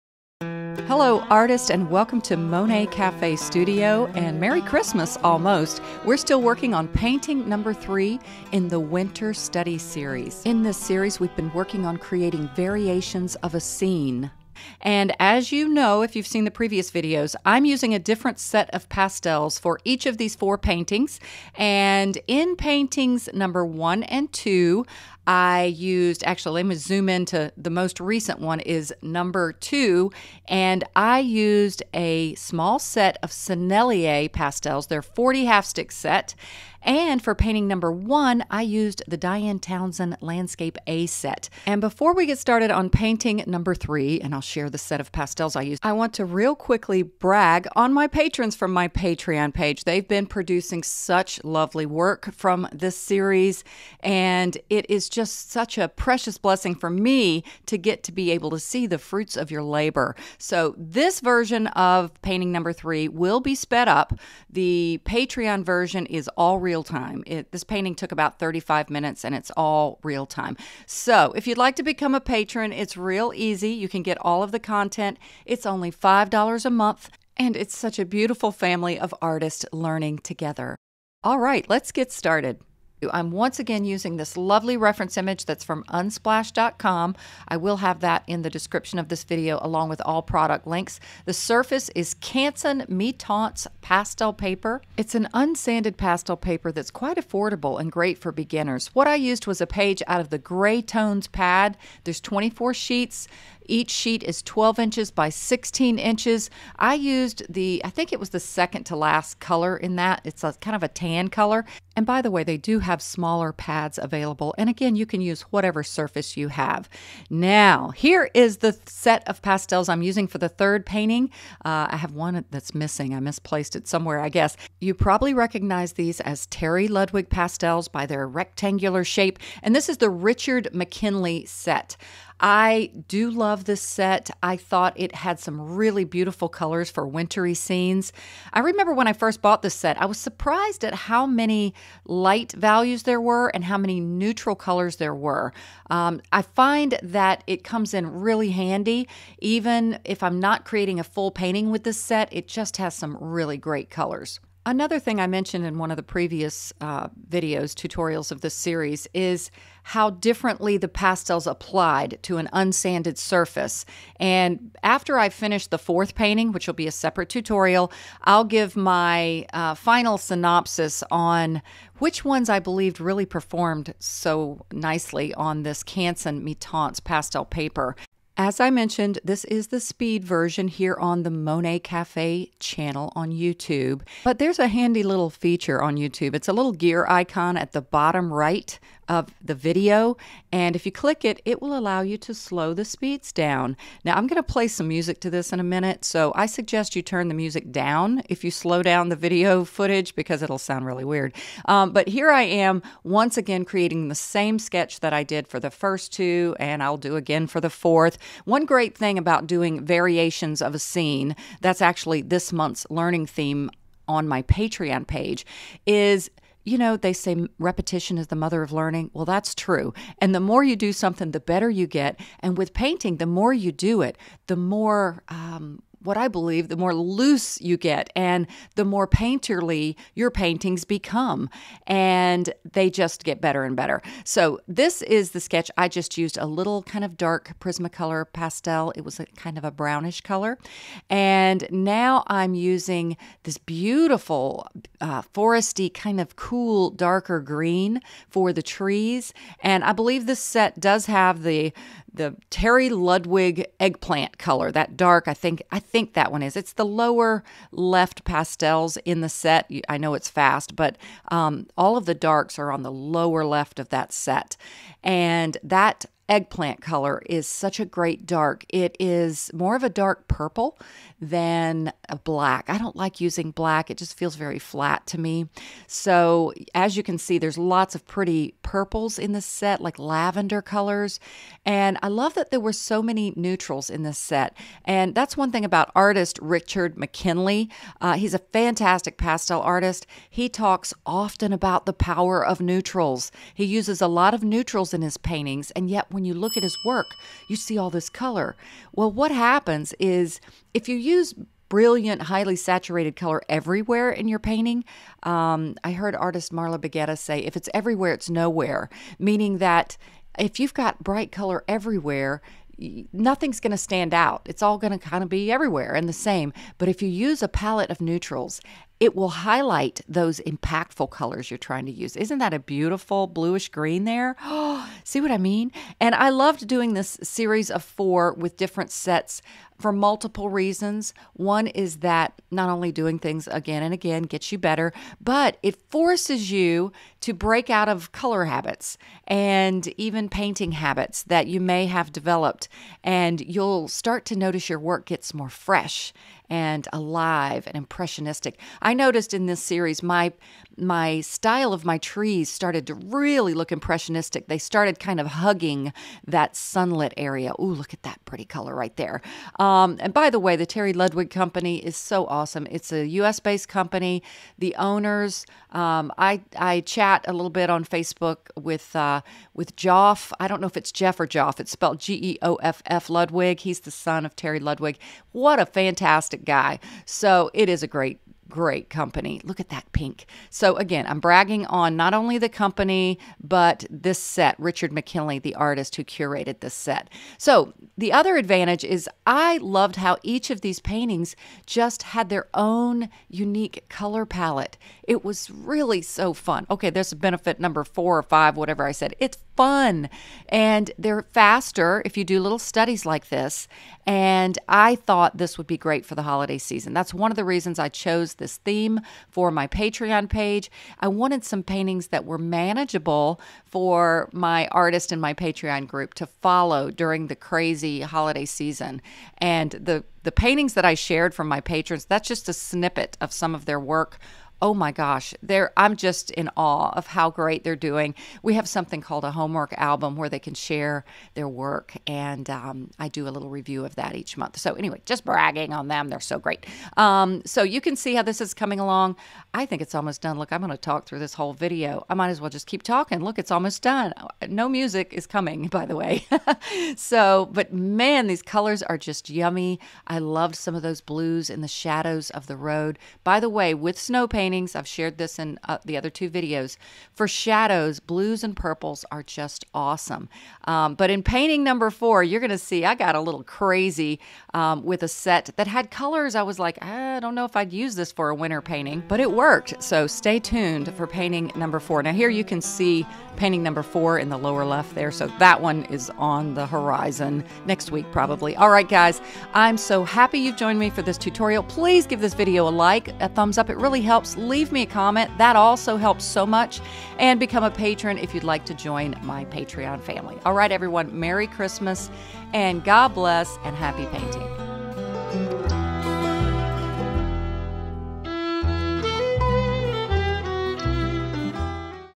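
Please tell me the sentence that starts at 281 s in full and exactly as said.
And I love that there were so many neutrals in this set.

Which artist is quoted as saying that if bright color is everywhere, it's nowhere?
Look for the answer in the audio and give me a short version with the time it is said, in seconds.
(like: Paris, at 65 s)
Marla Baggetta, at 306 s.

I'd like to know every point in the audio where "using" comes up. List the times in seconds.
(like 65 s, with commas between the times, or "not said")
17 s, 83 s, 120 s, 242 s, 273 s.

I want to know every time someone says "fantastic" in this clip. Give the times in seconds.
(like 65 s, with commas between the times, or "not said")
288 s, 375 s.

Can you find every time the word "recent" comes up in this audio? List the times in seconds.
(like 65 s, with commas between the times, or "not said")
27 s.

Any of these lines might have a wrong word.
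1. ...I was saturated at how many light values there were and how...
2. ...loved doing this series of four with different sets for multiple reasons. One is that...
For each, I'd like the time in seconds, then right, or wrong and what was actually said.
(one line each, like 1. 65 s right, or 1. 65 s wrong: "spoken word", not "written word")
1. 140 s wrong: "surprised", not "saturated"
2. 326 s right.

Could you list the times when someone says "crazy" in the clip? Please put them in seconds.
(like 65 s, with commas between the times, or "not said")
417 s, 463 s.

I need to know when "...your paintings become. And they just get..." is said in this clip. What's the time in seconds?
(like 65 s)
230 s.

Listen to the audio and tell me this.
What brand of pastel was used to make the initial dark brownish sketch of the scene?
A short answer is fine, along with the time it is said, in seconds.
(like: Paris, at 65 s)
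Prismacolor, at 237 s.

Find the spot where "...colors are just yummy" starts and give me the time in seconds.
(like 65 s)
448 s.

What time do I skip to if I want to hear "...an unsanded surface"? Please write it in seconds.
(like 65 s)
162 s.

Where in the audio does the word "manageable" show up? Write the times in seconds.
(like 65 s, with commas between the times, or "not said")
412 s.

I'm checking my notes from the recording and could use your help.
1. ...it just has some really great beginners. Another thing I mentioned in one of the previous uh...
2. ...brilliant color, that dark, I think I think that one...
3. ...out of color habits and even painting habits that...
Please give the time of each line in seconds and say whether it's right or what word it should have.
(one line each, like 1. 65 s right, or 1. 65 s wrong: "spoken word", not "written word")
1. 152 s wrong: "colors", not "beginners"
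2. 253 s wrong: "eggplant", not "brilliant"
3. 337 s right.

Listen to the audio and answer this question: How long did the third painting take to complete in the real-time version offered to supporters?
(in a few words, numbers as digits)
35 minutes.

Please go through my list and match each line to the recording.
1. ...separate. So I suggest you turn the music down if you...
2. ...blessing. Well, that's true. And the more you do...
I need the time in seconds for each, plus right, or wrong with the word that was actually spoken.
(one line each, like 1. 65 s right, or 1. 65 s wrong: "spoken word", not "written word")
1. 195 s wrong: "minute", not "separate"
2. 218 s wrong: "learning", not "blessing".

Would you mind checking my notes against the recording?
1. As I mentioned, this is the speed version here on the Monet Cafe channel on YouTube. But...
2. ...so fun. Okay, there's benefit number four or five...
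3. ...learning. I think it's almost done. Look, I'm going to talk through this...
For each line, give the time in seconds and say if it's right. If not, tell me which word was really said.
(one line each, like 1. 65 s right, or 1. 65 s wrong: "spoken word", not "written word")
1. 178 s right
2. 396 s right
3. 438 s wrong: "along", not "learning".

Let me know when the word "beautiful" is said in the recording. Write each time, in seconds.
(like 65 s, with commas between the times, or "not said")
78 s, 136 s, 243 s, 322 s.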